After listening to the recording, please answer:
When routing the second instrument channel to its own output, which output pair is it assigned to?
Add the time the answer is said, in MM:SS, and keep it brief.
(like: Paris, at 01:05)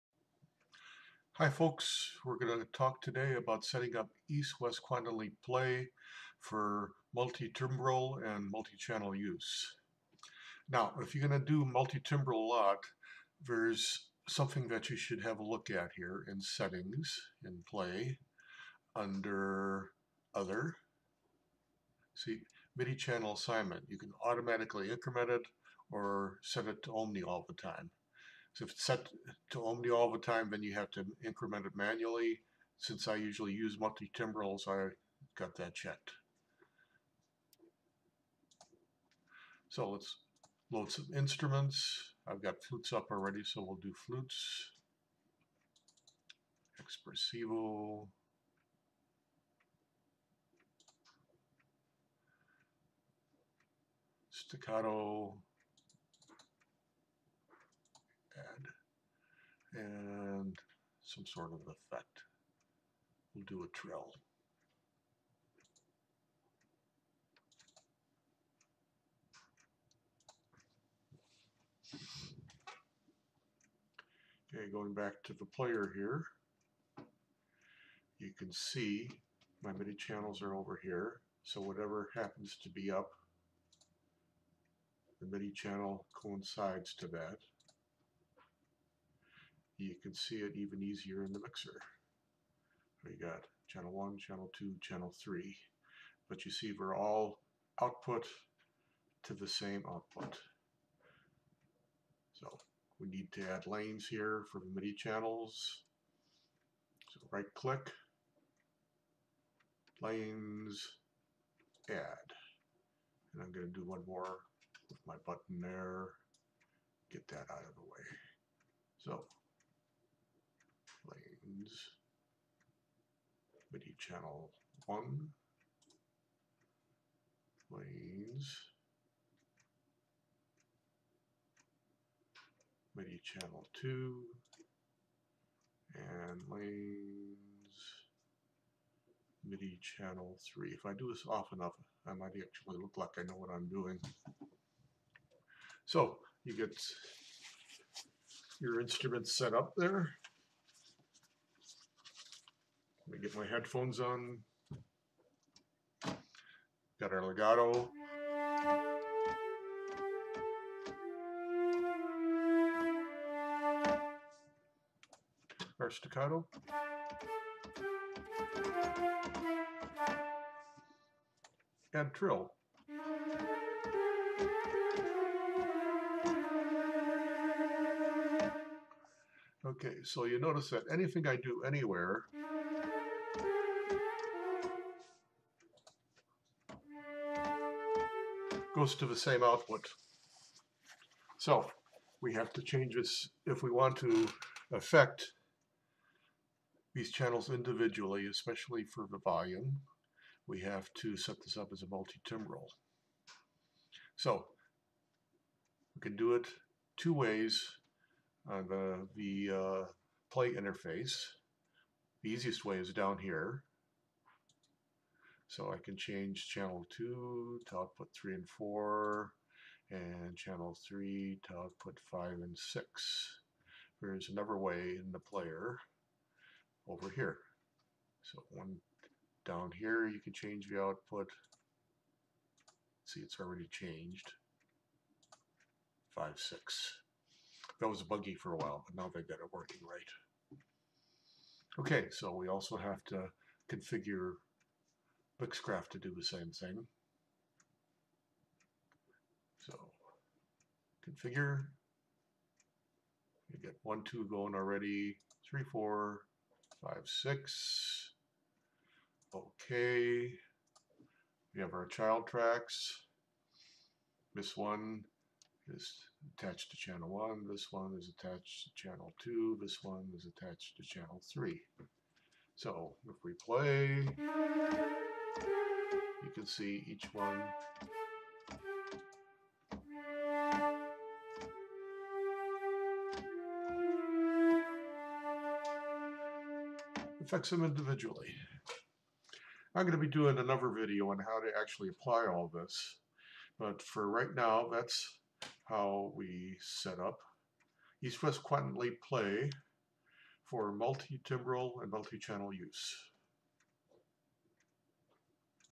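3 and 4, at 03:37.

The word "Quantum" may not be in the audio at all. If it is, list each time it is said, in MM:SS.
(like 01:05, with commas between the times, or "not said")
00:04, 04:58.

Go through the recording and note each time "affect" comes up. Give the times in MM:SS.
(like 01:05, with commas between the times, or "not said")
03:14, 04:47.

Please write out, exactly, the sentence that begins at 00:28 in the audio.
So if it's set to Omni all the time, then you have to increment it manually.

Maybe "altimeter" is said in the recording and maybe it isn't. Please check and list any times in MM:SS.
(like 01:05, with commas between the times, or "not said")
not said.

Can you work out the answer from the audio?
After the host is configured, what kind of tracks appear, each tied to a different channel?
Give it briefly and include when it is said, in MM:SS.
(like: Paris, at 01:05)
Child tracks, at 04:21.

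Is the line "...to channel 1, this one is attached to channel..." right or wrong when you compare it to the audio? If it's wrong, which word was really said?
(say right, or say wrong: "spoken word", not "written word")
right.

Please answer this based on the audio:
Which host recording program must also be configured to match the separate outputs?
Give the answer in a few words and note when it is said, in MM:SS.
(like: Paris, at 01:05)
Mixcraft, at 04:05.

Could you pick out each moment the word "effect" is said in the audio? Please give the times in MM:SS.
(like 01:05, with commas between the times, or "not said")
01:01.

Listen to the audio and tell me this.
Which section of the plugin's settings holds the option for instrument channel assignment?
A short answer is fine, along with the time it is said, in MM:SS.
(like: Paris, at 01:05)
Other, at 00:20.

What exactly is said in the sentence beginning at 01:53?
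And I'm going to do one more with my button there.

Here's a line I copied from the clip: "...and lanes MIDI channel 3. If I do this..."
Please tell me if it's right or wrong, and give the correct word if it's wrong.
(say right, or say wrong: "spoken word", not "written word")
right.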